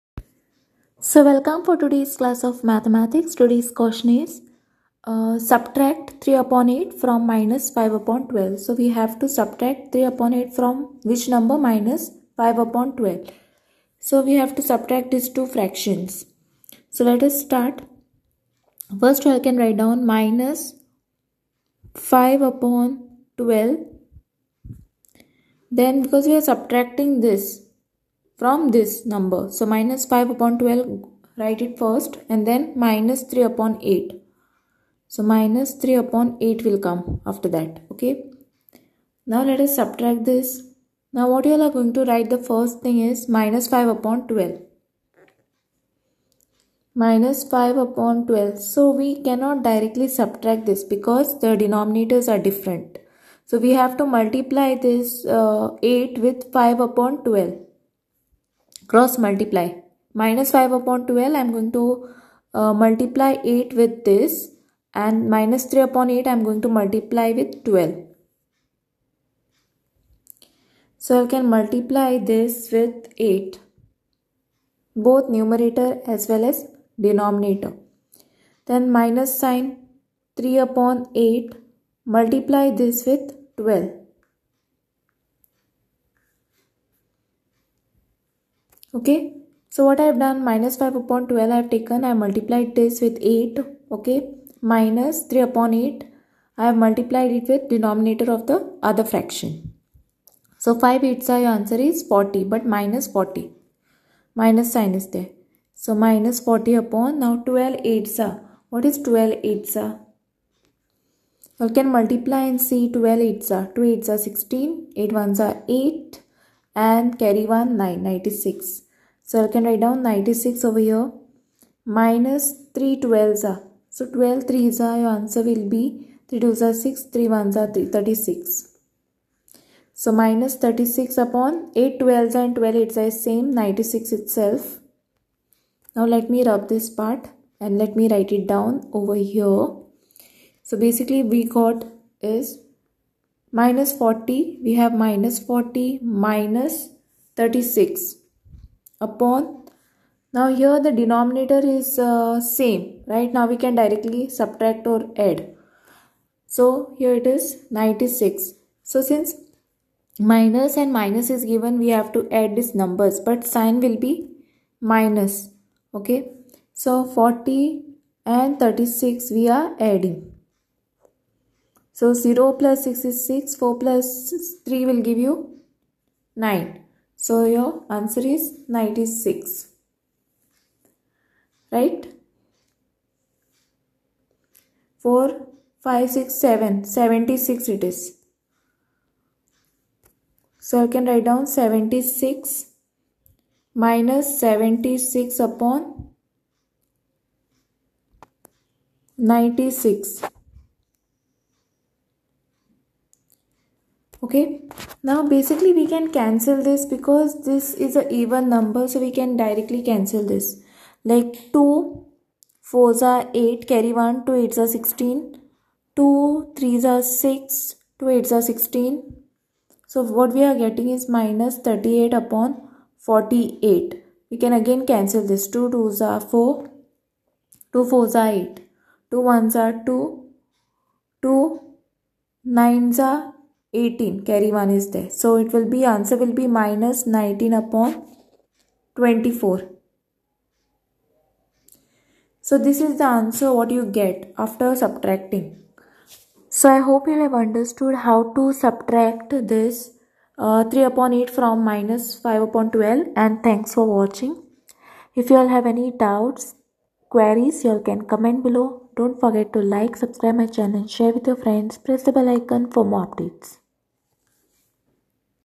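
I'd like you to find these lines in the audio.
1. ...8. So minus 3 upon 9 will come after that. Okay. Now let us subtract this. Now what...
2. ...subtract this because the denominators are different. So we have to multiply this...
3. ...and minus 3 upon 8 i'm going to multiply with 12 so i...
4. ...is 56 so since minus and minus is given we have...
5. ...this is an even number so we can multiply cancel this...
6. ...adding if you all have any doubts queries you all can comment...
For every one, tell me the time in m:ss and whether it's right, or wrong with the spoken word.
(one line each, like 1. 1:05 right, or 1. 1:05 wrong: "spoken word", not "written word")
1. 0:33 wrong: "8", not "9"
2. 0:50 right
3. 1:05 right
4. 2:37 wrong: "96", not "56"
5. 3:27 wrong: "directly", not "multiply"
6. 4:13 wrong: "watching", not "adding".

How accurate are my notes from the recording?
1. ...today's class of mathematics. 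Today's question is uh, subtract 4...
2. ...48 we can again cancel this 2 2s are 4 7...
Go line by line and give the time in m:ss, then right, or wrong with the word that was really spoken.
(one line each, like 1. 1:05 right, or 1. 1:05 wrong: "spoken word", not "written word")
1. 0:01 wrong: "3", not "4"
2. 3:43 wrong: "2", not "7".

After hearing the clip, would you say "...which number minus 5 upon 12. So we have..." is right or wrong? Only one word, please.
right.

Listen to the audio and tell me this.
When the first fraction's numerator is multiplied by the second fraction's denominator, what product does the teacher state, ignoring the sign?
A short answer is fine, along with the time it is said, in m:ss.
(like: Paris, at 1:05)
40, at 1:41.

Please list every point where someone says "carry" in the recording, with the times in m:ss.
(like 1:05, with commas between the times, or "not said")
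1:57, 3:33, 3:54.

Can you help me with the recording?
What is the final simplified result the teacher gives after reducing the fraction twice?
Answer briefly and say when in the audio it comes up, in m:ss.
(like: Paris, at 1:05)
-19/24, at 3:56.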